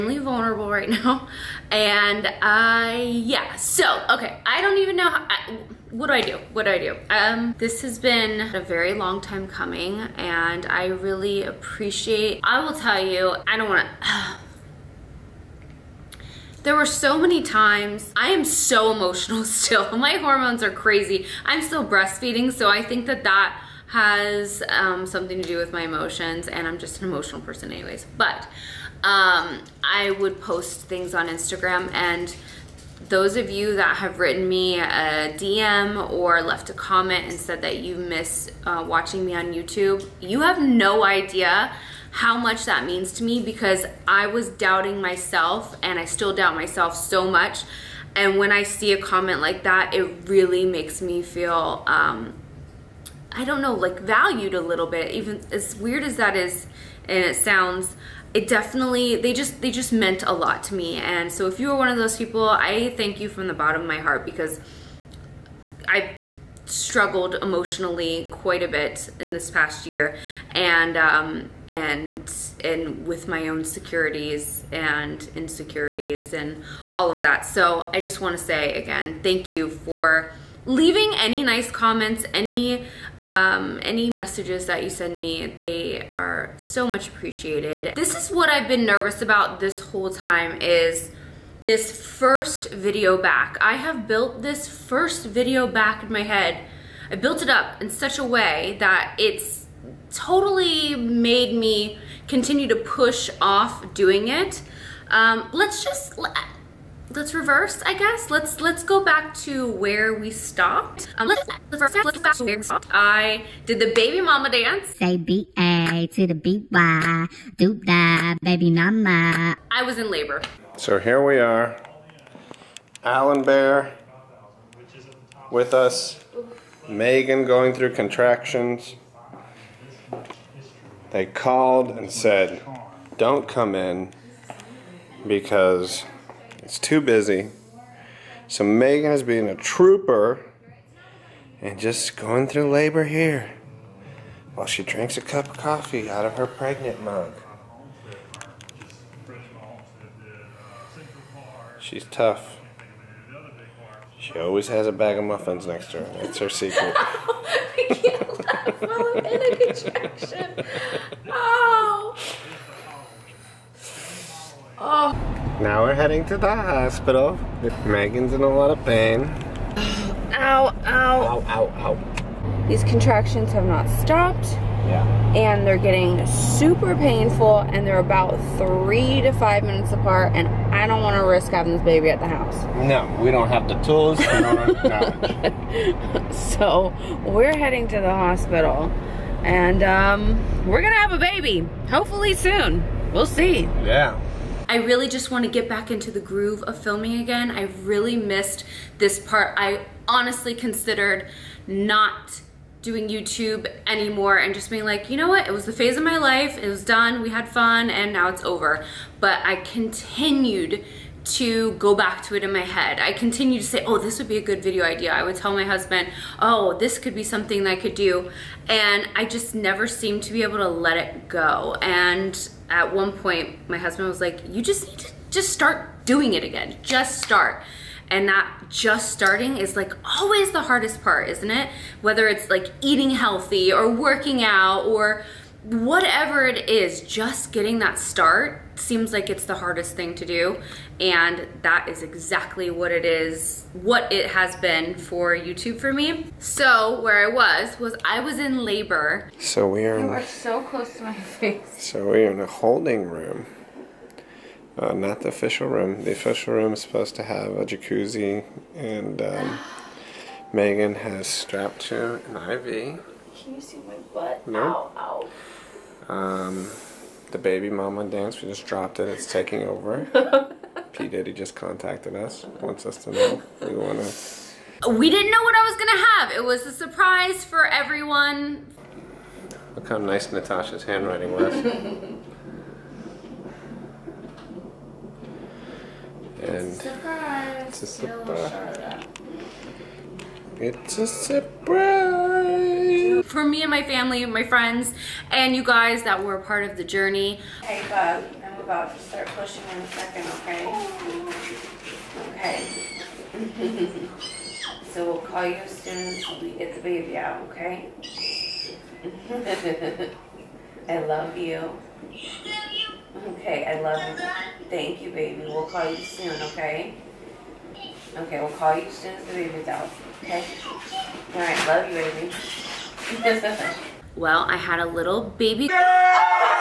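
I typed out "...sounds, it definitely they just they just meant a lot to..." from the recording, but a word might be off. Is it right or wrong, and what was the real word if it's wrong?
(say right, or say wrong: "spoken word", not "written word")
right.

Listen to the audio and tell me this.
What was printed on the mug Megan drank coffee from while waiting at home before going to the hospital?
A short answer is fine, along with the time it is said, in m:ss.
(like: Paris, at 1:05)
pregnant, at 2:26.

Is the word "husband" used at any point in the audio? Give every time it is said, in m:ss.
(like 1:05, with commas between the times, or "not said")
3:35, 3:43.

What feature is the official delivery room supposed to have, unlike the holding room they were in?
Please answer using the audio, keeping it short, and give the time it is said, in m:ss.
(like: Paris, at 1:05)
a jacuzzi, at 4:17.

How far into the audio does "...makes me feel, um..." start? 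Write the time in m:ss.
0:50.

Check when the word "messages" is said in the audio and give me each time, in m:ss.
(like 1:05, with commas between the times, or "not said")
1:24.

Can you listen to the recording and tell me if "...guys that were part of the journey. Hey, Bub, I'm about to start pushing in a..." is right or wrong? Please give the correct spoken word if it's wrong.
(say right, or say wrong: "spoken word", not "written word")
right.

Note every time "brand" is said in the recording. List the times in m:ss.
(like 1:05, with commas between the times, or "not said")
not said.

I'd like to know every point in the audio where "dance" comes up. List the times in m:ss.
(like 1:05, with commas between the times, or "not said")
1:54, 4:28.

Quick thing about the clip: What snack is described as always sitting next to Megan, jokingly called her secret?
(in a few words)
muffins.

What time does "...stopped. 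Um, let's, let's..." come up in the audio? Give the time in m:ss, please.
1:50.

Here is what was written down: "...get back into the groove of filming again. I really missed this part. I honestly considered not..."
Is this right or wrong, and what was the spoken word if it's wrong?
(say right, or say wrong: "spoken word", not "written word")
right.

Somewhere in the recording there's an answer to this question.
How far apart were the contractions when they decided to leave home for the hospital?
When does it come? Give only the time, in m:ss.
2:58.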